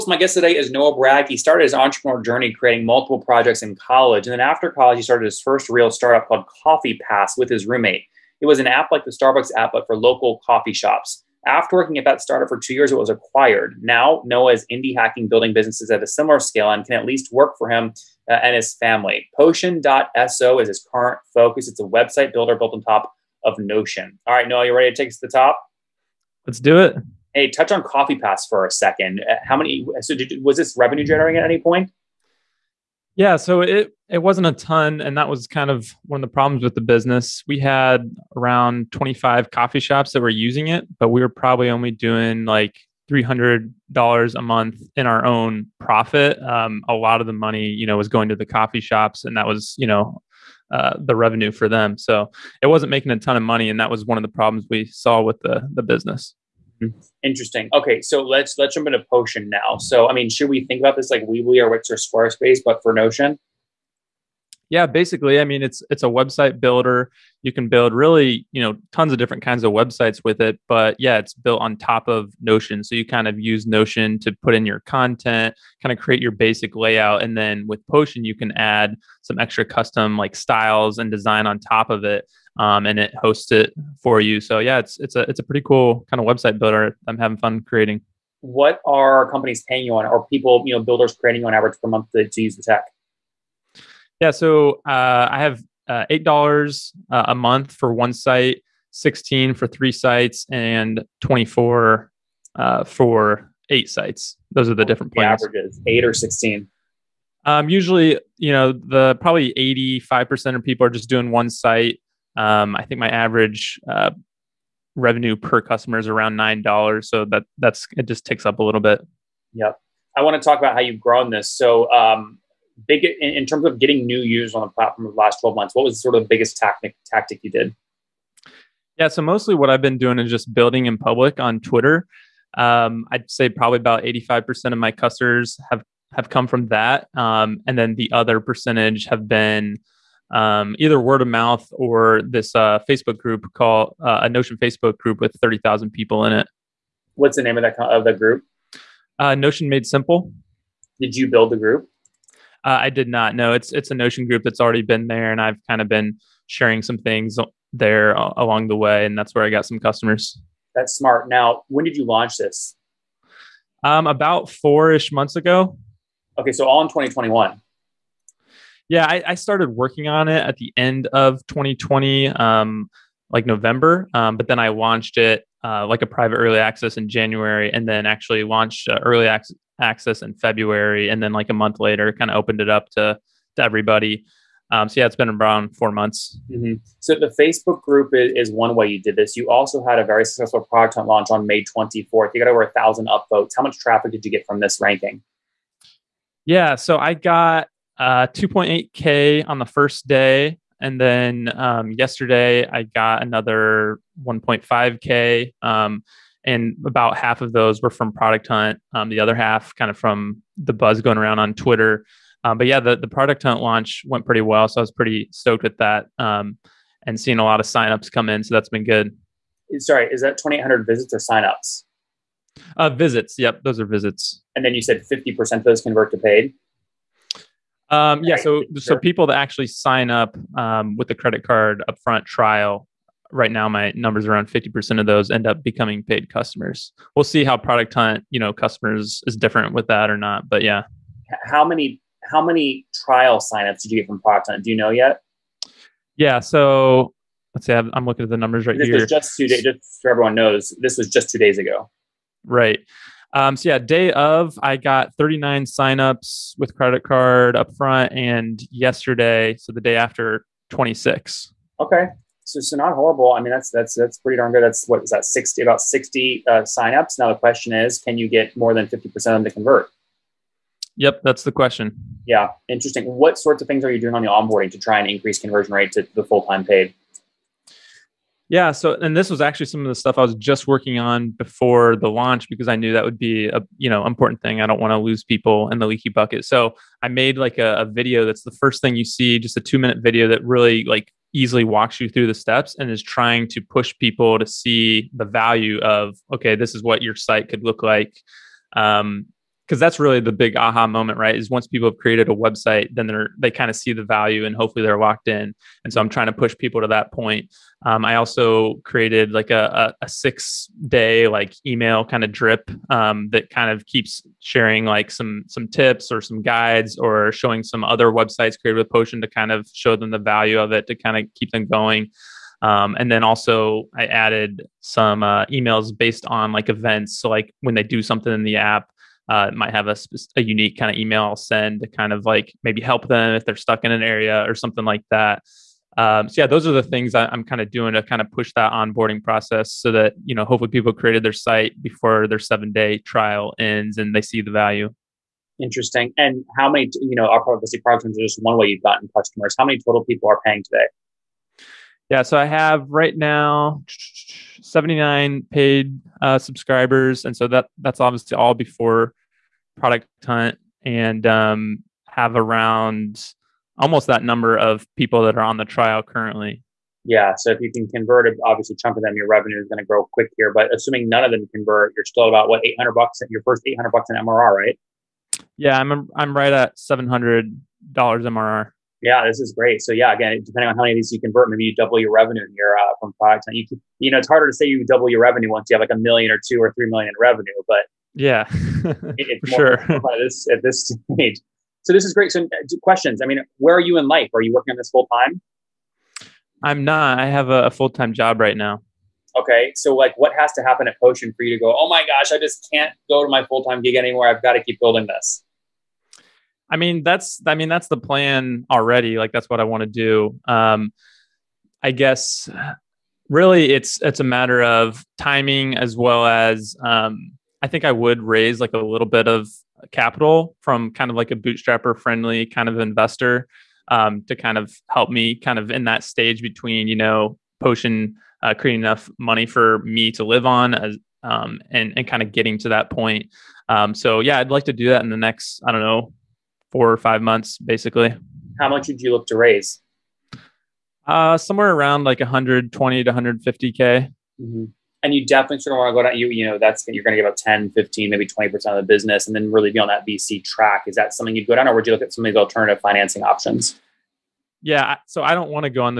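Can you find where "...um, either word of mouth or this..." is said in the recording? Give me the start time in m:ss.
2:20.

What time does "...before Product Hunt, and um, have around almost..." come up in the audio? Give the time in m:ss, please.
5:58.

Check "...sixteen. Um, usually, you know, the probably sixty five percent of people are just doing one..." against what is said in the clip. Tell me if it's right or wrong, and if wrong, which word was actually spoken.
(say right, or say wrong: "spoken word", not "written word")
wrong: "eighty", not "sixty".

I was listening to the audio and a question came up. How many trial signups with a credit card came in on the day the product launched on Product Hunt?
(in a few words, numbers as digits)
39.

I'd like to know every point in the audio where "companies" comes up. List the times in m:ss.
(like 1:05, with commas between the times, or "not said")
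1:29.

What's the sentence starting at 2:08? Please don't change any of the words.
Yeah, so mostly what I've been doing is just building in public on Twitter.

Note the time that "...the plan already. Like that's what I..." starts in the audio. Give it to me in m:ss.
6:47.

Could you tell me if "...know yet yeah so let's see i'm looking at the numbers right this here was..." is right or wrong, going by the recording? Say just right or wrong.
right.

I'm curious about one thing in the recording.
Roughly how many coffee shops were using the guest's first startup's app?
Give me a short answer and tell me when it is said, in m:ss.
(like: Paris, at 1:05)
25, at 0:38.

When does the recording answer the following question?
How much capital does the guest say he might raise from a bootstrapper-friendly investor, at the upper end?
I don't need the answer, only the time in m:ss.
7:23.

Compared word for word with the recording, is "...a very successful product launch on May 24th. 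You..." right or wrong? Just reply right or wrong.
right.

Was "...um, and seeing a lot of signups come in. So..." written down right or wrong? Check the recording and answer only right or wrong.
right.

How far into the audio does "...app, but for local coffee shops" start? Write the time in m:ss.
0:09.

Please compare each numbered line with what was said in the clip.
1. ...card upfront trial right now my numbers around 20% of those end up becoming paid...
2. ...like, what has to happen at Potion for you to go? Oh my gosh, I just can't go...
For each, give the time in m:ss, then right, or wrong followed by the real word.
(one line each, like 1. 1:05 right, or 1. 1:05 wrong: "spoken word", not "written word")
1. 3:51 wrong: "50", not "20"
2. 6:39 right.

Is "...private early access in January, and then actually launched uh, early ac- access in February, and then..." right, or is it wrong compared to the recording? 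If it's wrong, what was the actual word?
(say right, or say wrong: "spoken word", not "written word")
right.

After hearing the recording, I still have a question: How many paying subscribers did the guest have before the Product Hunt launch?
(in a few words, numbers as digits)
79.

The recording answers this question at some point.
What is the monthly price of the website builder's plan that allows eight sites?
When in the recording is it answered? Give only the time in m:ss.
1:41.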